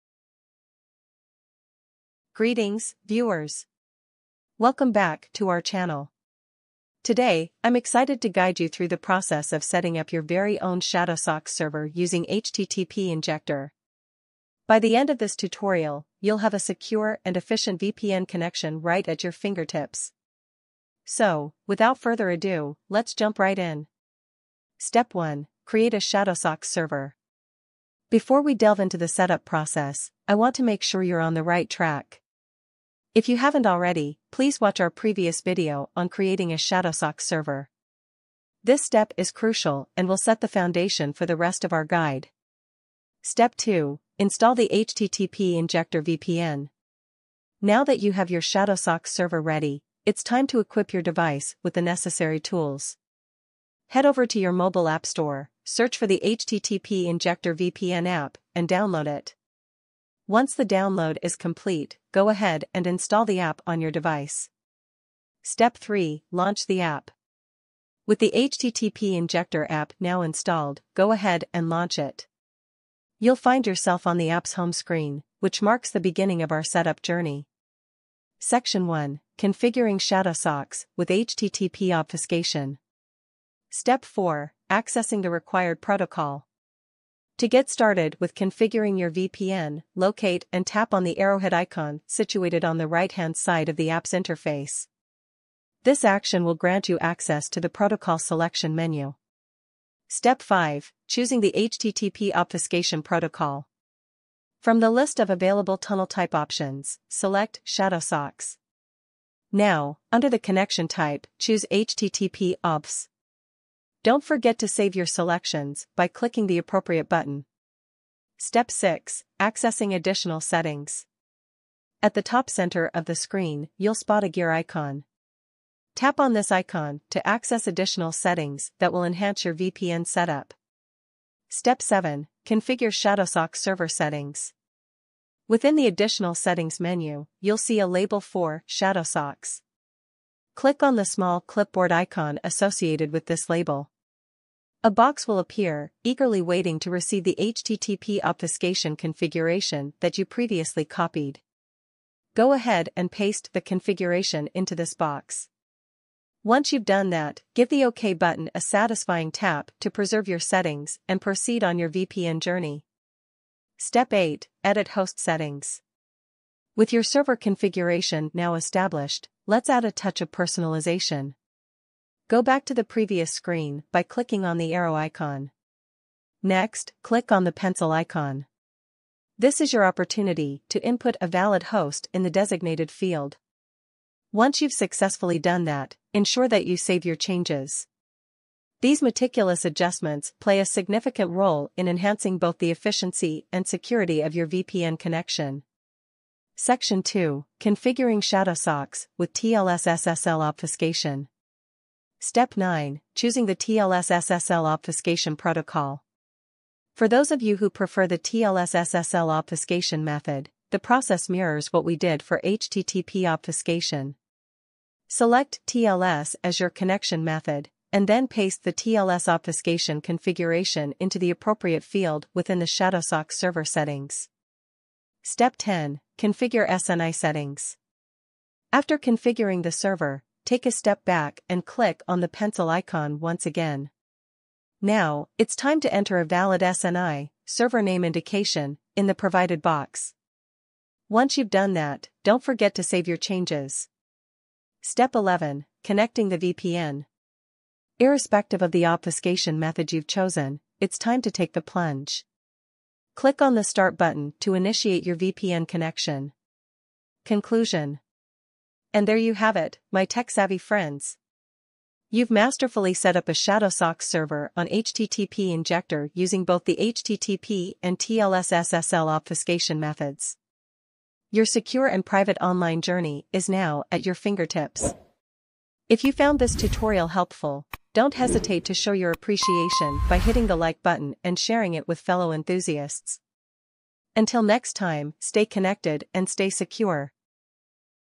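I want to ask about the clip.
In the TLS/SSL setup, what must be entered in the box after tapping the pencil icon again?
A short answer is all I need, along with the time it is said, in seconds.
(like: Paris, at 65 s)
SNI (server name indication), at 236 s.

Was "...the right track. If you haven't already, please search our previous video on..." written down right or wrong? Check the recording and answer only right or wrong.
wrong.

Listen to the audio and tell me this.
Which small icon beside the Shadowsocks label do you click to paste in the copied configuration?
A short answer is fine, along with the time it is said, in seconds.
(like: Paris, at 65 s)
clipboard icon, at 141 s.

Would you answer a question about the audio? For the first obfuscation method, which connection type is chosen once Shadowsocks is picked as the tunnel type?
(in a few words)
HTTP obfs.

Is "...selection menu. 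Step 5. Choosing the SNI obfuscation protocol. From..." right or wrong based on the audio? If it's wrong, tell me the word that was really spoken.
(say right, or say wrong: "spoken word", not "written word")
wrong: "HTTP", not "SNI".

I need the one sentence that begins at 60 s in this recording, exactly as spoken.
Once the download is complete, go ahead and install the app on your device.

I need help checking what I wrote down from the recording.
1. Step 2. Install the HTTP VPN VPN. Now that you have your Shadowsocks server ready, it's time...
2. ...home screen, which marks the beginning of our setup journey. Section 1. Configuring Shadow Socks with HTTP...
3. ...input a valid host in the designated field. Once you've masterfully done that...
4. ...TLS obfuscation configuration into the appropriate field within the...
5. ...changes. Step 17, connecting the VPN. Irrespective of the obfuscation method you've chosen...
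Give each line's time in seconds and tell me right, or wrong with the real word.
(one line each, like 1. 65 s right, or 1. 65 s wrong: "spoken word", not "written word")
1. 43 s wrong: "Injector", not "VPN"
2. 74 s right
3. 180 s wrong: "successfully", not "masterfully"
4. 218 s right
5. 243 s wrong: "11", not "17".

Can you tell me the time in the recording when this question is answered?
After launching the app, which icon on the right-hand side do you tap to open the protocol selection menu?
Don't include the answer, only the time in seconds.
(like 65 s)
91 s.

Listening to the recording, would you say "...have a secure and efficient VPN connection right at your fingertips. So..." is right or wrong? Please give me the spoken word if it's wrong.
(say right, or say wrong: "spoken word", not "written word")
right.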